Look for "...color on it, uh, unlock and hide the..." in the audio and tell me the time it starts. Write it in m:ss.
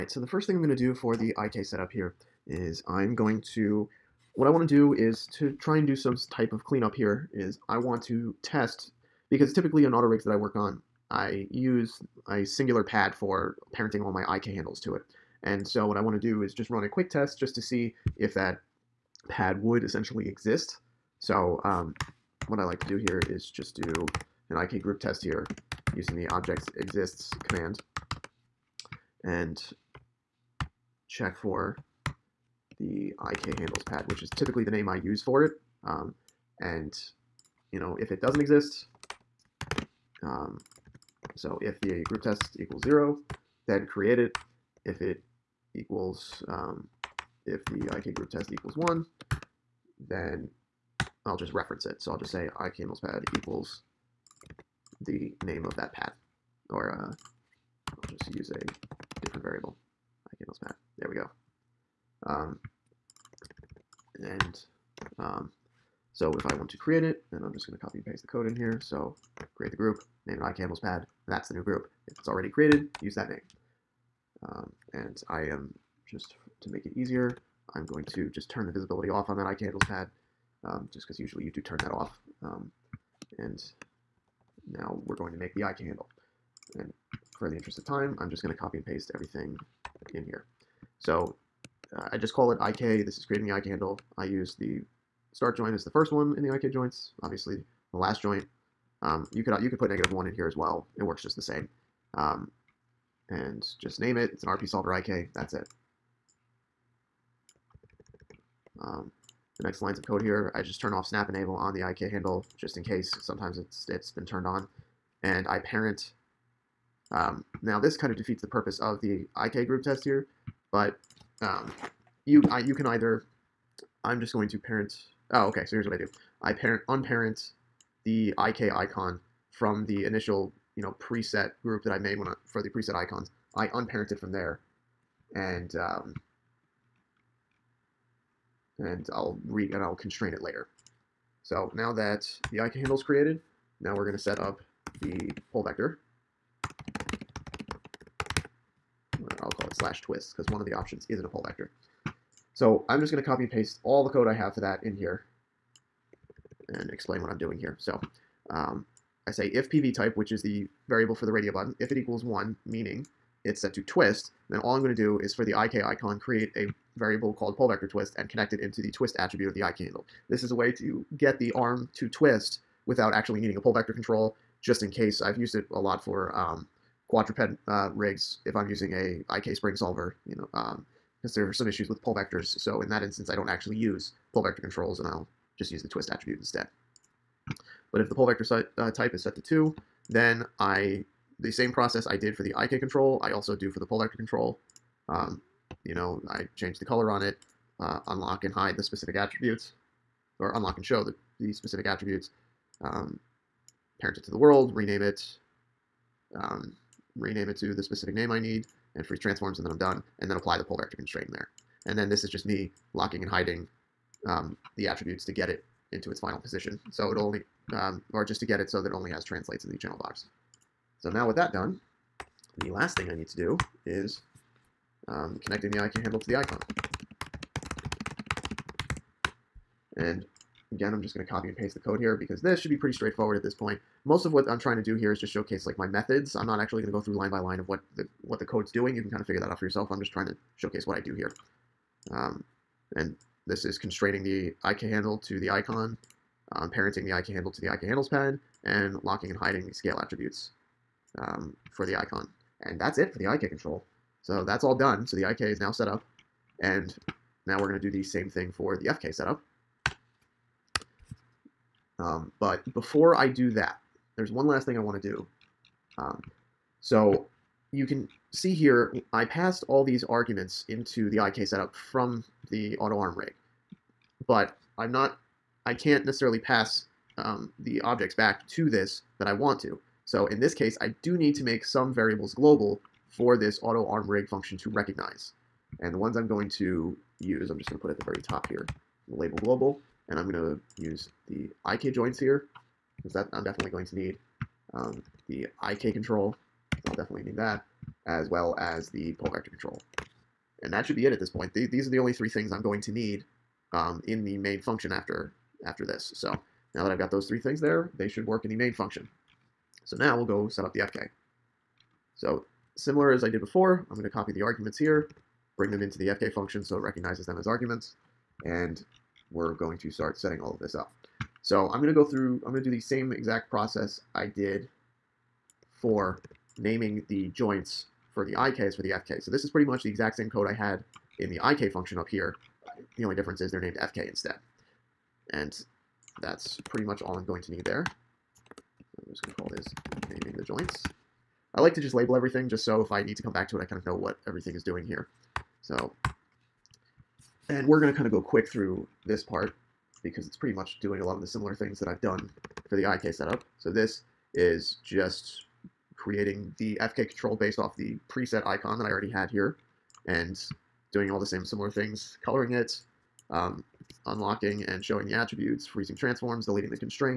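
3:16.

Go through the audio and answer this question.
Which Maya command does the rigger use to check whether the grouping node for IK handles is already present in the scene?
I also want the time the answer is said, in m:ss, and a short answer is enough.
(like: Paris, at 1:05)
objects exists, at 0:26.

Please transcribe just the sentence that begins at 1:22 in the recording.
Um, and now we're going to make the IK handle.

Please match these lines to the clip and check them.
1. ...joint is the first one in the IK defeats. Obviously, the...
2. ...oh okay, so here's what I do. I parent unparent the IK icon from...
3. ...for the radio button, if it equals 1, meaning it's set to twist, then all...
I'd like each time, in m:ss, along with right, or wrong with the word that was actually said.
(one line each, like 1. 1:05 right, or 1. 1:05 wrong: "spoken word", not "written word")
1. 1:35 wrong: "joints", not "defeats"
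2. 2:05 right
3. 2:41 right.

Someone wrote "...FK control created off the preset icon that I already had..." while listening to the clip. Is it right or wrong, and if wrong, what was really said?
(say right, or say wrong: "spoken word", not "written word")
wrong: "based", not "created".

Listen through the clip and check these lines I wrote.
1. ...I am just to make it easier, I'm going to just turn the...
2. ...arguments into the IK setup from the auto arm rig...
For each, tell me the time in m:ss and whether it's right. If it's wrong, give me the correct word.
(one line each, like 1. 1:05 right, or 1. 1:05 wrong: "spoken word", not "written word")
1. 1:15 right
2. 4:30 right.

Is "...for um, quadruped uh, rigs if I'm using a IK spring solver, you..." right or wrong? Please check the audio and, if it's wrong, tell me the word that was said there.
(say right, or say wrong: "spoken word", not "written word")
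right.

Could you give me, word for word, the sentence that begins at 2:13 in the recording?
I unparent it from there and um, and I'll re and I'll constrain it later.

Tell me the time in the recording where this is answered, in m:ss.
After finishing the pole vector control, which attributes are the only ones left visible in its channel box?
3:39.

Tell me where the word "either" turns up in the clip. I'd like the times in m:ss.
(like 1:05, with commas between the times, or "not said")
2:02.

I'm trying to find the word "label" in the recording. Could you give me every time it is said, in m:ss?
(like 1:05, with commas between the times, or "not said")
4:49, 5:41.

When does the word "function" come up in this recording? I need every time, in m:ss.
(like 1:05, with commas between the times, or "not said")
4:44, 5:04, 5:08, 5:16, 5:31.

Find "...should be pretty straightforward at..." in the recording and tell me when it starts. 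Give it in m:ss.
3:52.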